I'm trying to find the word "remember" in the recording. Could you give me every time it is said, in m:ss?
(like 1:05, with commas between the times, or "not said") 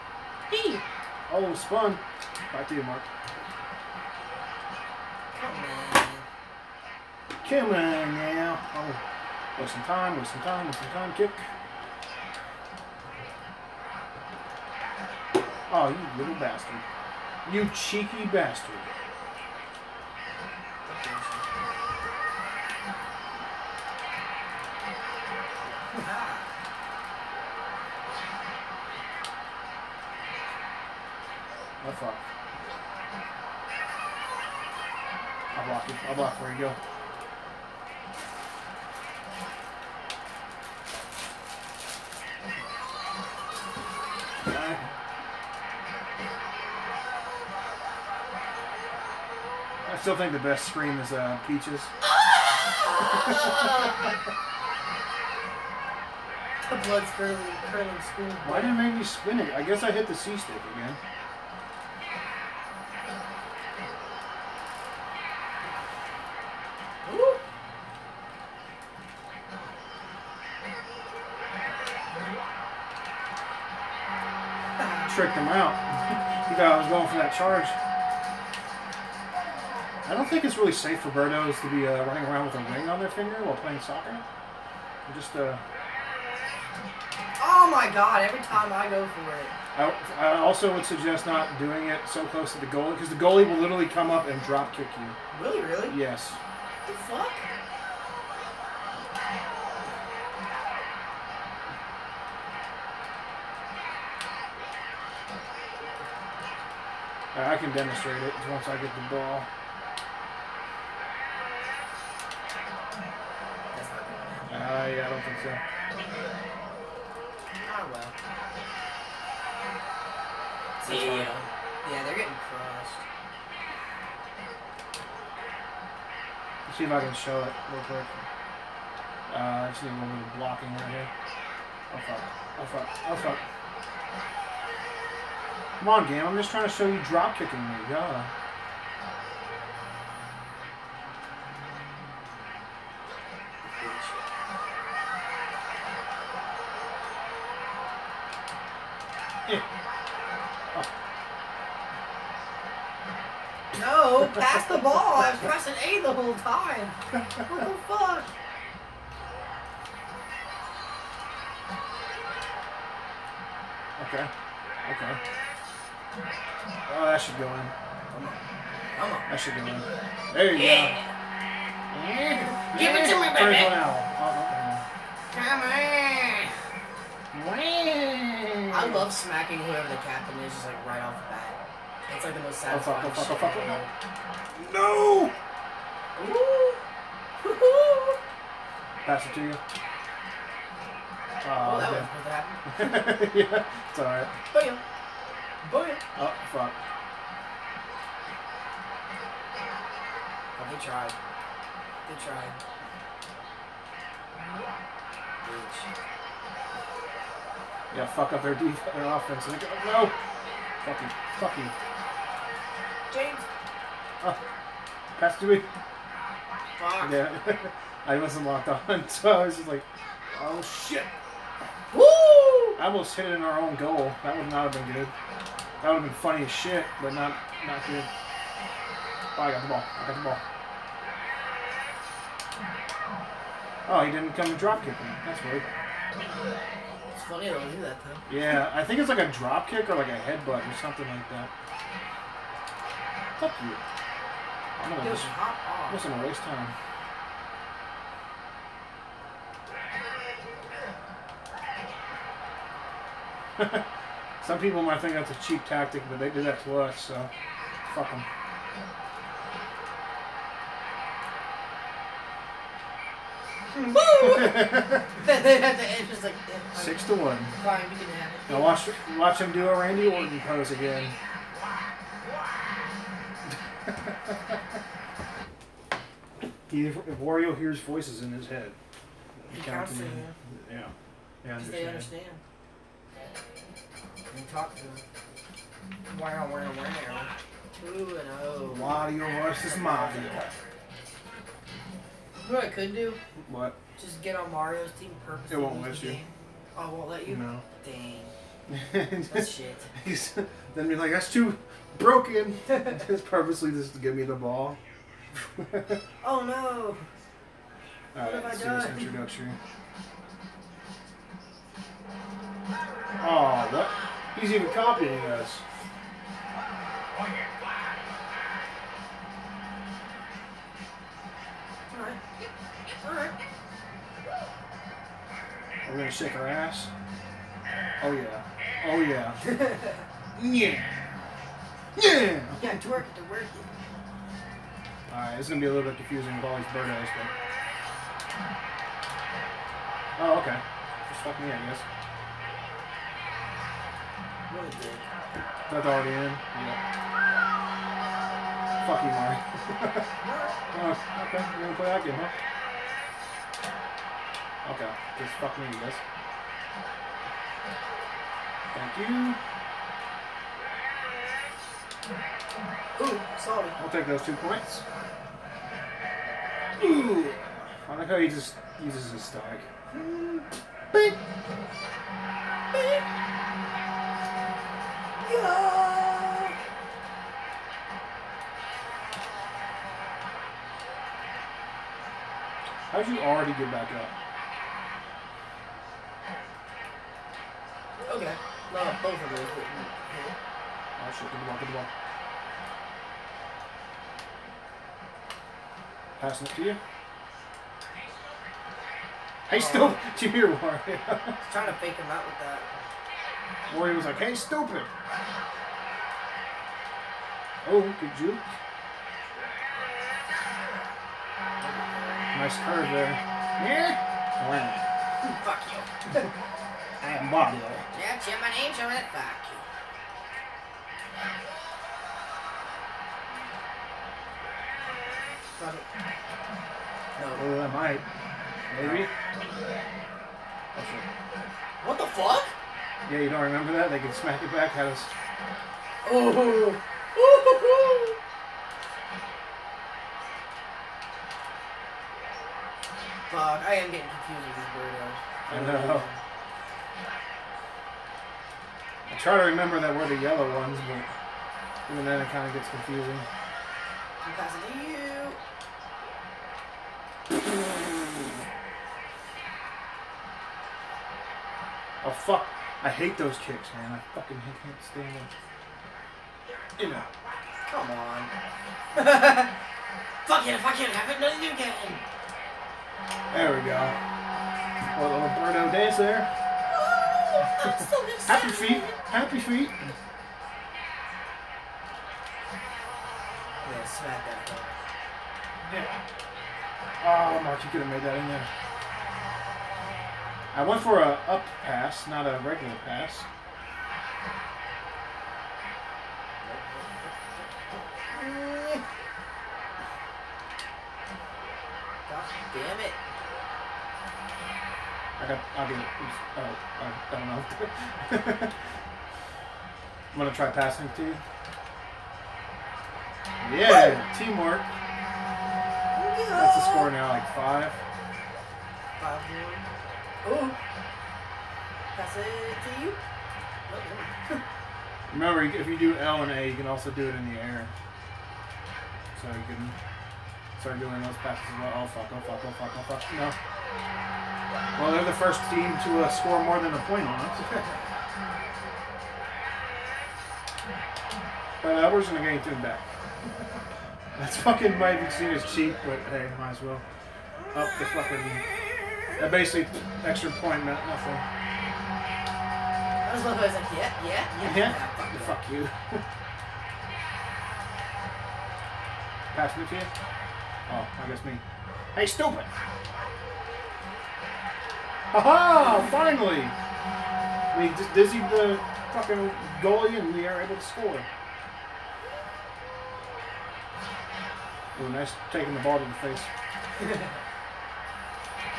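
7:13, 7:29, 8:45.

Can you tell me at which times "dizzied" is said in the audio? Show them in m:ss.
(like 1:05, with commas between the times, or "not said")
9:27.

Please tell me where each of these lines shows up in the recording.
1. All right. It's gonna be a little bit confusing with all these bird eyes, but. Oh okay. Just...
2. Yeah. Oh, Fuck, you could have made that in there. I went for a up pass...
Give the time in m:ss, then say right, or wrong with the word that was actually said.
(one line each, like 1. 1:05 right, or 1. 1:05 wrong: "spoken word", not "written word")
1. 5:35 right
2. 8:05 wrong: "Mark", not "Fuck".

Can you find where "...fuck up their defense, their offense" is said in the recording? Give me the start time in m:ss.
3:28.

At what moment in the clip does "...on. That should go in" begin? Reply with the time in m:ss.
2:49.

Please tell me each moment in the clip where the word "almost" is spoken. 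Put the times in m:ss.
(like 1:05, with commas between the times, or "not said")
3:42.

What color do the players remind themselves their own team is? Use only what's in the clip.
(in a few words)
Yellow.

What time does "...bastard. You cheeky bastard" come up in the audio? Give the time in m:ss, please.
0:16.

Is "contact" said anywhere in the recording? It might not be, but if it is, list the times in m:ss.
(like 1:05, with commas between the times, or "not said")
not said.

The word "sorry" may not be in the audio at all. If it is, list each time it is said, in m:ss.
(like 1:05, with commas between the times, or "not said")
6:03.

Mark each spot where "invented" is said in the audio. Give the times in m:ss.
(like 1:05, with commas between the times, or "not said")
not said.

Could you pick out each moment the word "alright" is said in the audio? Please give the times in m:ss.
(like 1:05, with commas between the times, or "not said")
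3:13, 5:08.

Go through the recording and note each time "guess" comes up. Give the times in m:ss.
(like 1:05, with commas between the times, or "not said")
0:59, 5:41, 9:21.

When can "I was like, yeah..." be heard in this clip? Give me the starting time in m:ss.
9:11.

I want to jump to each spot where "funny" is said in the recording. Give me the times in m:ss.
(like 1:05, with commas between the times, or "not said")
3:46, 3:57.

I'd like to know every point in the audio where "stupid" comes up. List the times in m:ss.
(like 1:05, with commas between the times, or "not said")
6:44, 9:22.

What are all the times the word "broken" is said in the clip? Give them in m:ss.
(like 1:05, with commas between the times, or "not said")
5:01.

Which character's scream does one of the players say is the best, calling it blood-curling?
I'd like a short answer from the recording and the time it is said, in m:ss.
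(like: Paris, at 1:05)
Peach, at 0:51.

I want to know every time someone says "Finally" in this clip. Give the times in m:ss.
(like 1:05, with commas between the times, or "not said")
9:25.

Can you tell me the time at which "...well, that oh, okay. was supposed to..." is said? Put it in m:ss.
3:11.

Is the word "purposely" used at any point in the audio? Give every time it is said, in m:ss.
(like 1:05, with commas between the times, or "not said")
4:55, 5:03.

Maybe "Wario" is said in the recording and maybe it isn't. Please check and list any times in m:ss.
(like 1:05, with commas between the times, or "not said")
4:37, 4:48.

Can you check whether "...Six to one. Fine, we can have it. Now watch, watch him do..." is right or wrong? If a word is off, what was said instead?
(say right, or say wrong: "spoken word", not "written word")
right.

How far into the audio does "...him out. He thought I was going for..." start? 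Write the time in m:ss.
1:15.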